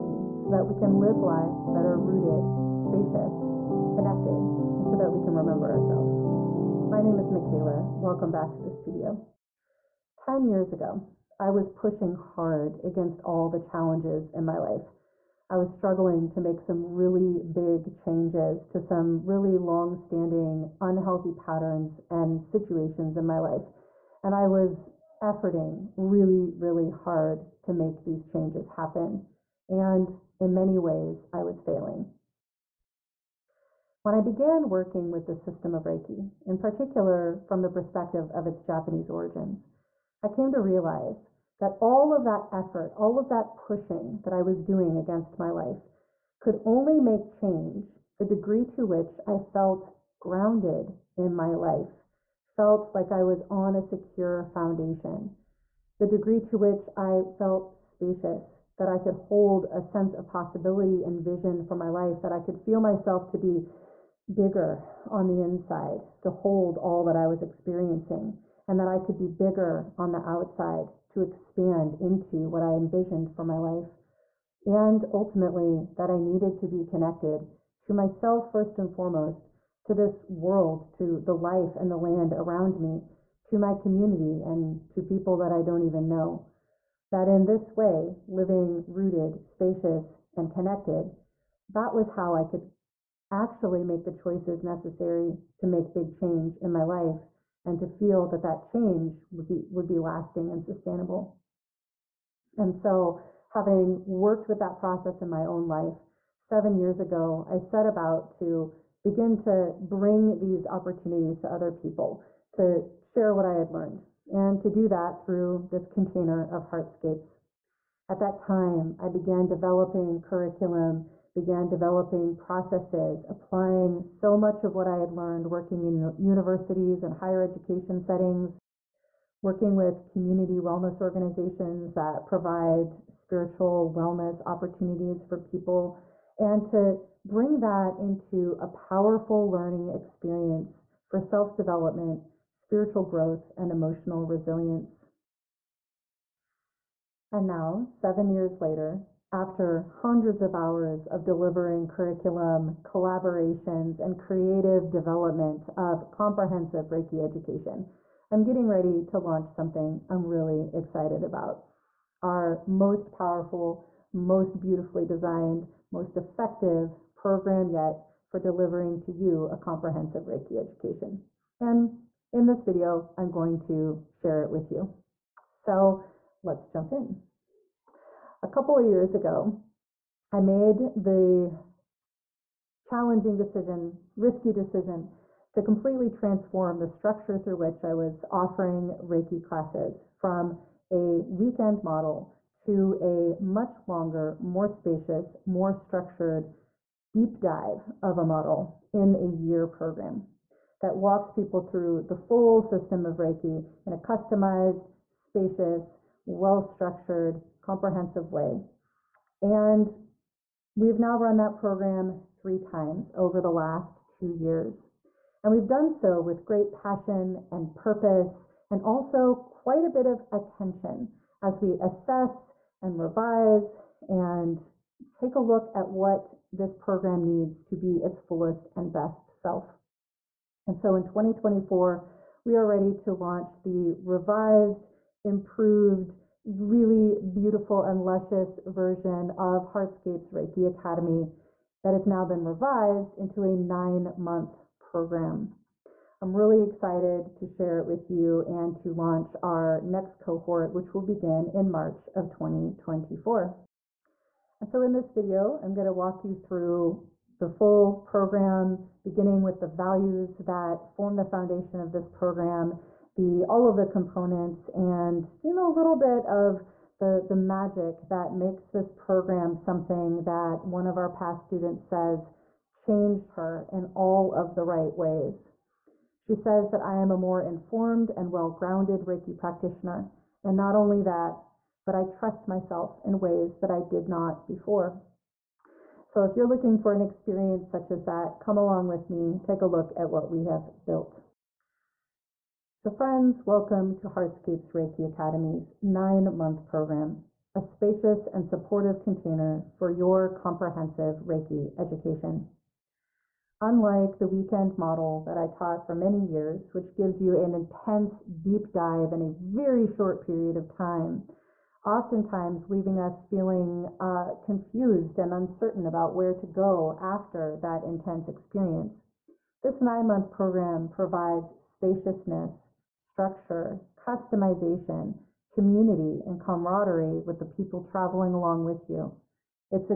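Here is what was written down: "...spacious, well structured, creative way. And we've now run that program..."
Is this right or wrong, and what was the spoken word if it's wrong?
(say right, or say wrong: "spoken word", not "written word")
wrong: "comprehensive", not "creative".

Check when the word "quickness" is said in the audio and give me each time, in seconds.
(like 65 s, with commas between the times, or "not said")
not said.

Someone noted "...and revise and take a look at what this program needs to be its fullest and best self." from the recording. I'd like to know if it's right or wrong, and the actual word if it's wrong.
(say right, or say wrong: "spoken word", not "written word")
right.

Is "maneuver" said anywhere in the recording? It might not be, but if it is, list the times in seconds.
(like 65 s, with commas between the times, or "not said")
not said.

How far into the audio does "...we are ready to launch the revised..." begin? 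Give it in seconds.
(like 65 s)
232 s.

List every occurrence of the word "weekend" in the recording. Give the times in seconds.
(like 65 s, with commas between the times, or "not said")
191 s, 304 s.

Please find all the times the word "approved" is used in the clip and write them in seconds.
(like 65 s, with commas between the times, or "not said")
not said.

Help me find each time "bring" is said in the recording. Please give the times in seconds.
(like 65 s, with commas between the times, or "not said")
109 s, 137 s.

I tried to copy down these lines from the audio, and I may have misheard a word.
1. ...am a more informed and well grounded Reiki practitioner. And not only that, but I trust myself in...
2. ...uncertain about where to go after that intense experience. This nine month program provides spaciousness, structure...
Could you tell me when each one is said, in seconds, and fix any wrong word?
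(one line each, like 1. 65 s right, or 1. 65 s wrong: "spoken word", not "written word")
1. 276 s right
2. 315 s right.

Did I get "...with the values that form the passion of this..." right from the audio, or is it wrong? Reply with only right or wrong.
wrong.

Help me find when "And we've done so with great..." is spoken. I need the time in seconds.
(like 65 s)
215 s.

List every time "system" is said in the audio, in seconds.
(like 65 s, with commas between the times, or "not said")
35 s, 202 s.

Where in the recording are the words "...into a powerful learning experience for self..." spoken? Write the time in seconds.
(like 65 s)
137 s.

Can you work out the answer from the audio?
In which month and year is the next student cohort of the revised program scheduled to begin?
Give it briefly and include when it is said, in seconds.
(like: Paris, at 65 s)
March 2024, at 251 s.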